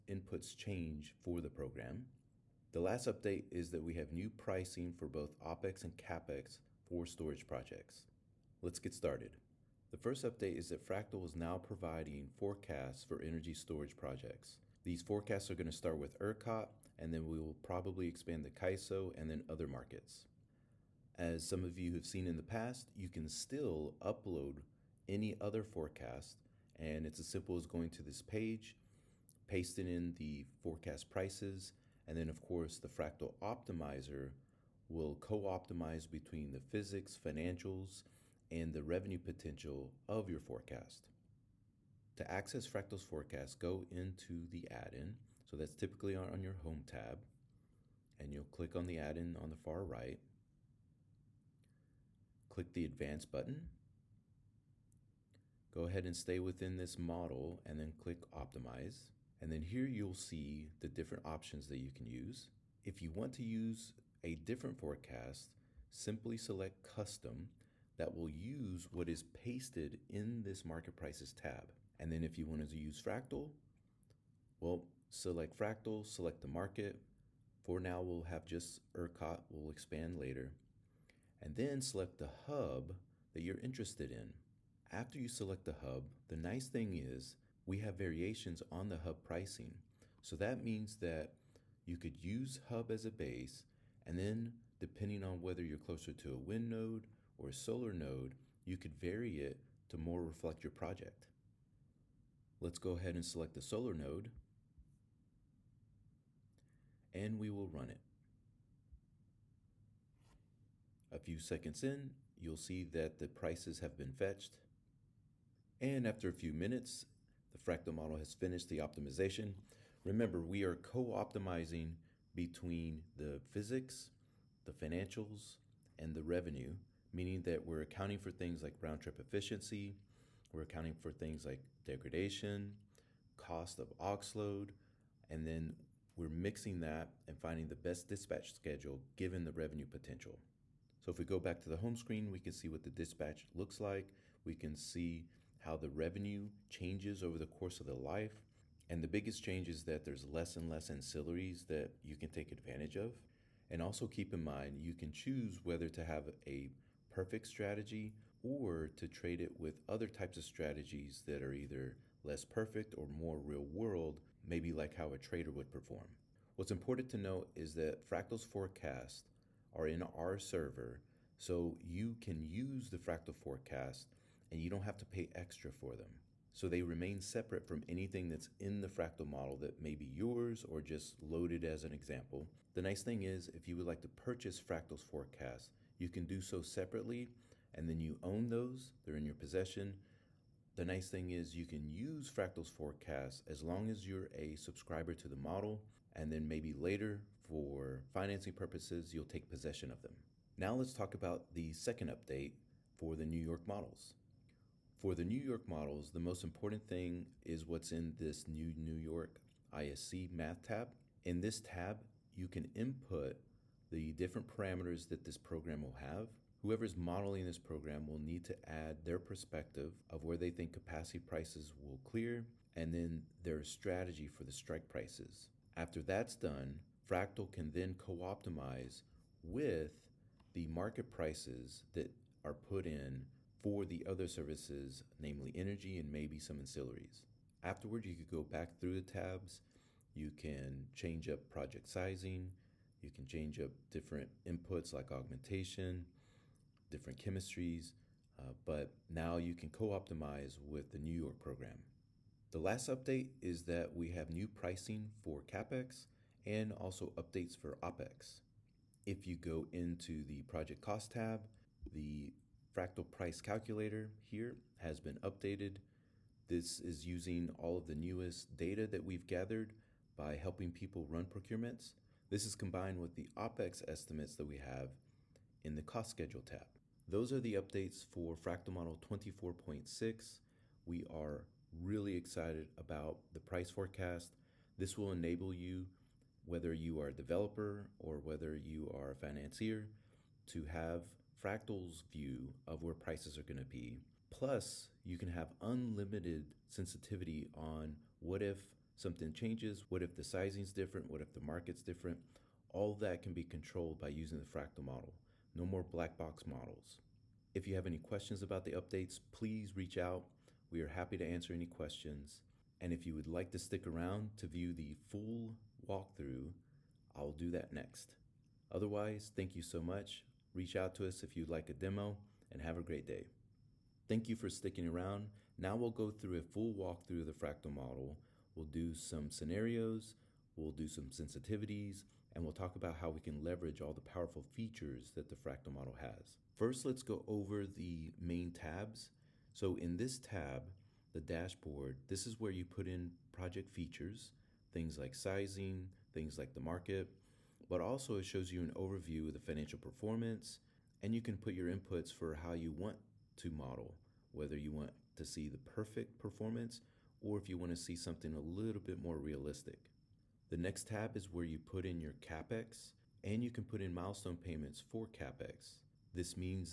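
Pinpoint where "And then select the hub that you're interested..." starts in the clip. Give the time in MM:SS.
01:21.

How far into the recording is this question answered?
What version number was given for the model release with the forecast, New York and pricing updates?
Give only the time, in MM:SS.
04:38.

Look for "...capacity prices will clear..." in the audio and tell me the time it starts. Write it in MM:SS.
03:40.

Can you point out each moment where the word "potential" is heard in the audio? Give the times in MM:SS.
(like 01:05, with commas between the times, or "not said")
00:39, 02:19.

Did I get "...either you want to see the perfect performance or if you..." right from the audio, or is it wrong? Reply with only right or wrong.
wrong.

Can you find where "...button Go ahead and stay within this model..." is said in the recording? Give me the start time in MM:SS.
00:53.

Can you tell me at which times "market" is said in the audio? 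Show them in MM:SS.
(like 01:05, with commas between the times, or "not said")
00:19, 01:10, 01:16, 03:50, 05:01, 05:46.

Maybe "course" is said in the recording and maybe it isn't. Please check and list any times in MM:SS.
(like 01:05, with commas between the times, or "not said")
00:32, 02:27.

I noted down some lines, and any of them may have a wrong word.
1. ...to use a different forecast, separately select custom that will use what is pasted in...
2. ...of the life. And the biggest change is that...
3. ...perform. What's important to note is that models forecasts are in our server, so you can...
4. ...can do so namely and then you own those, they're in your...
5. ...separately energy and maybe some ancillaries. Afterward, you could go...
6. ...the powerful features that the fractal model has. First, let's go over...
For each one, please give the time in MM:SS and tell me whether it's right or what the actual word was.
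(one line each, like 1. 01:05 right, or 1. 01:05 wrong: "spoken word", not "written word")
1. 01:03 wrong: "simply", not "separately"
2. 02:27 right
3. 02:45 wrong: "fractals", not "models"
4. 03:06 wrong: "separately", not "namely"
5. 03:55 wrong: "namely", not "separately"
6. 05:33 right.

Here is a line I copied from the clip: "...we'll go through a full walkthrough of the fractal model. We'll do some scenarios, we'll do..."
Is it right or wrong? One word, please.
right.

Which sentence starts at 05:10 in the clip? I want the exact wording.
We are happy to answer any questions.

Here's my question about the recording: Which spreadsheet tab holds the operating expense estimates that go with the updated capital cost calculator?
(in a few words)
cost schedule tab.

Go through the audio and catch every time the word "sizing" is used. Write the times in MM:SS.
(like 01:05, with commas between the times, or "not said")
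04:01, 05:00, 05:45.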